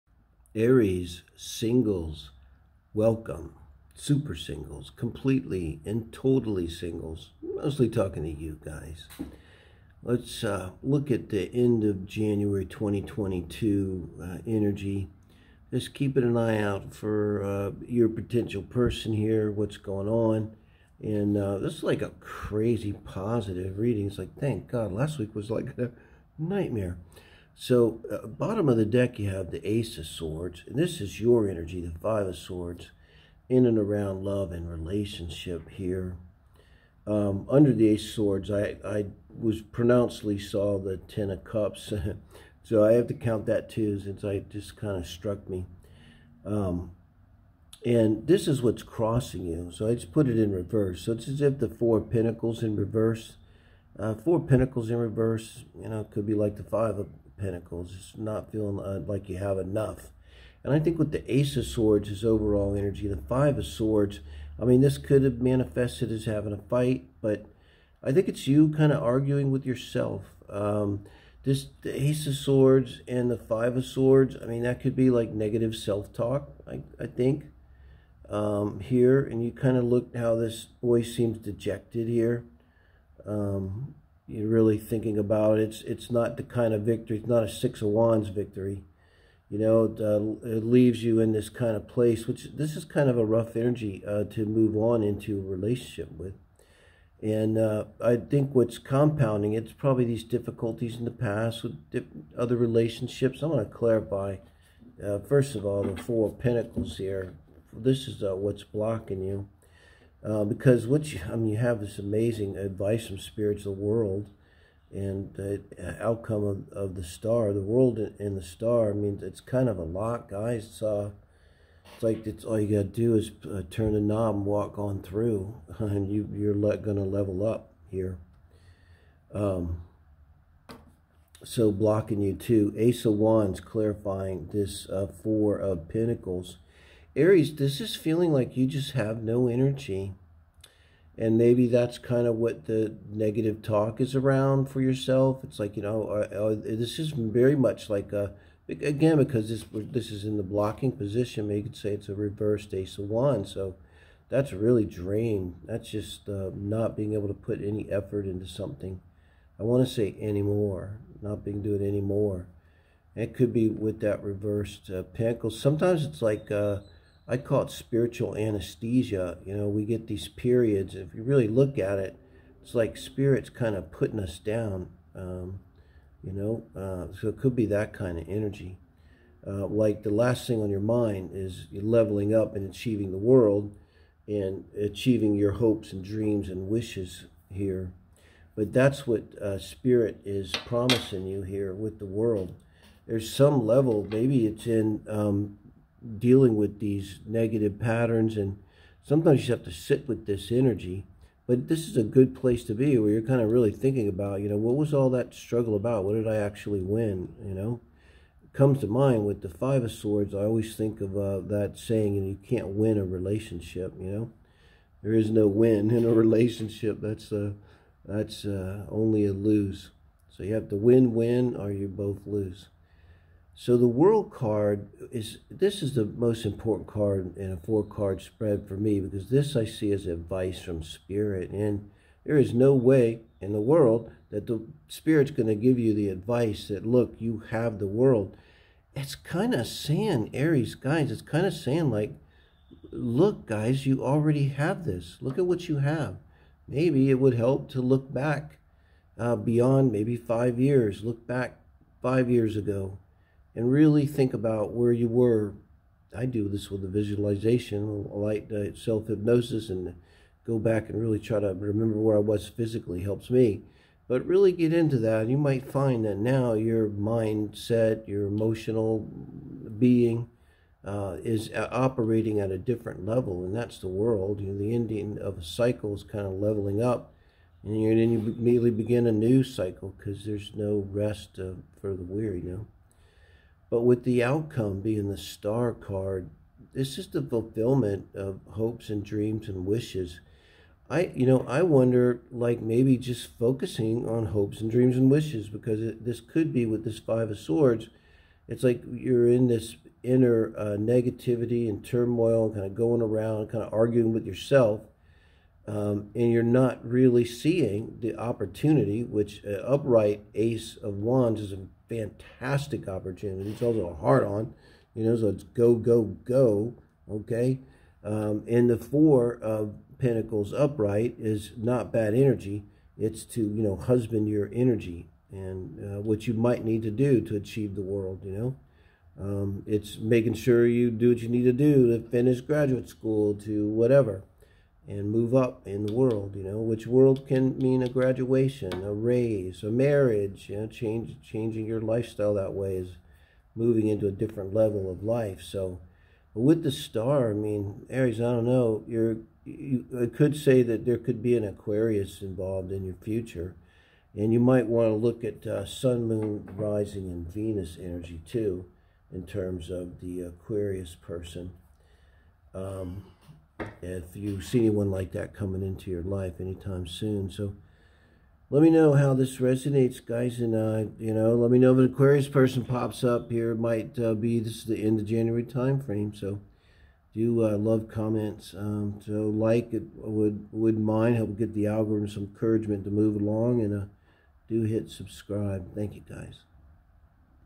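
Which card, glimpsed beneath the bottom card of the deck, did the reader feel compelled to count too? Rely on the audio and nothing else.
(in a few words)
Ten of Cups.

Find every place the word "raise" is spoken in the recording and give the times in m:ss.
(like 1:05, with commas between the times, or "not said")
5:38.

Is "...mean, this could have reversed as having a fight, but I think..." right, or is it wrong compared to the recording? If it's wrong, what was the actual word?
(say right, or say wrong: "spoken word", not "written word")
wrong: "manifested", not "reversed".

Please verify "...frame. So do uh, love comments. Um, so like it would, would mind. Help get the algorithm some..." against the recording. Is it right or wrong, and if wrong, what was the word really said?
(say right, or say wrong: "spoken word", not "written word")
right.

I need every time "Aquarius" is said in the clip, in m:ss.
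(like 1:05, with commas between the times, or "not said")
5:51, 6:00, 6:11.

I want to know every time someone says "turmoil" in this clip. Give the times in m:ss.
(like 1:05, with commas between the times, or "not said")
5:01.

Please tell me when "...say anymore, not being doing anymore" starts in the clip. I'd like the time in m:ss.
2:39.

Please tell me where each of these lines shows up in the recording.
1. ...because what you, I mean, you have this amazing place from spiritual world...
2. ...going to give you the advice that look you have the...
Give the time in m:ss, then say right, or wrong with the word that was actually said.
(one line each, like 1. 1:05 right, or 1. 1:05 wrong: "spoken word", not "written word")
1. 1:50 wrong: "advice", not "place"
2. 3:55 right.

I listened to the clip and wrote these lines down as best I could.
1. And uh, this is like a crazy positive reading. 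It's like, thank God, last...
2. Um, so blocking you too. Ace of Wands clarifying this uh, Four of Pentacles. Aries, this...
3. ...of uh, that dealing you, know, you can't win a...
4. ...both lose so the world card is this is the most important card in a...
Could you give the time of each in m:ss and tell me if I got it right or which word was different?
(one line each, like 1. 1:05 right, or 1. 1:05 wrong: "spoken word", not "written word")
1. 0:21 right
2. 2:09 right
3. 3:31 wrong: "saying", not "dealing"
4. 3:41 right.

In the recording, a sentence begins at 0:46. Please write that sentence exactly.
Um, and this is what's crossing you, so I just put it in reverse.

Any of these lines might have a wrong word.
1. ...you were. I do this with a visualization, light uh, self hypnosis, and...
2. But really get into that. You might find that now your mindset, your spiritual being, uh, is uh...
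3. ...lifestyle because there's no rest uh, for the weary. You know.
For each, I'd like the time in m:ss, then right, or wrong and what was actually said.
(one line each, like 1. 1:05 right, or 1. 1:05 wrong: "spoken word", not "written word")
1. 4:14 right
2. 4:24 wrong: "emotional", not "spiritual"
3. 4:39 wrong: "cycle", not "lifestyle".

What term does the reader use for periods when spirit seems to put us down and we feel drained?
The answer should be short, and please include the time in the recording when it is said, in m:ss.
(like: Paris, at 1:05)
spiritual anesthesia, at 2:47.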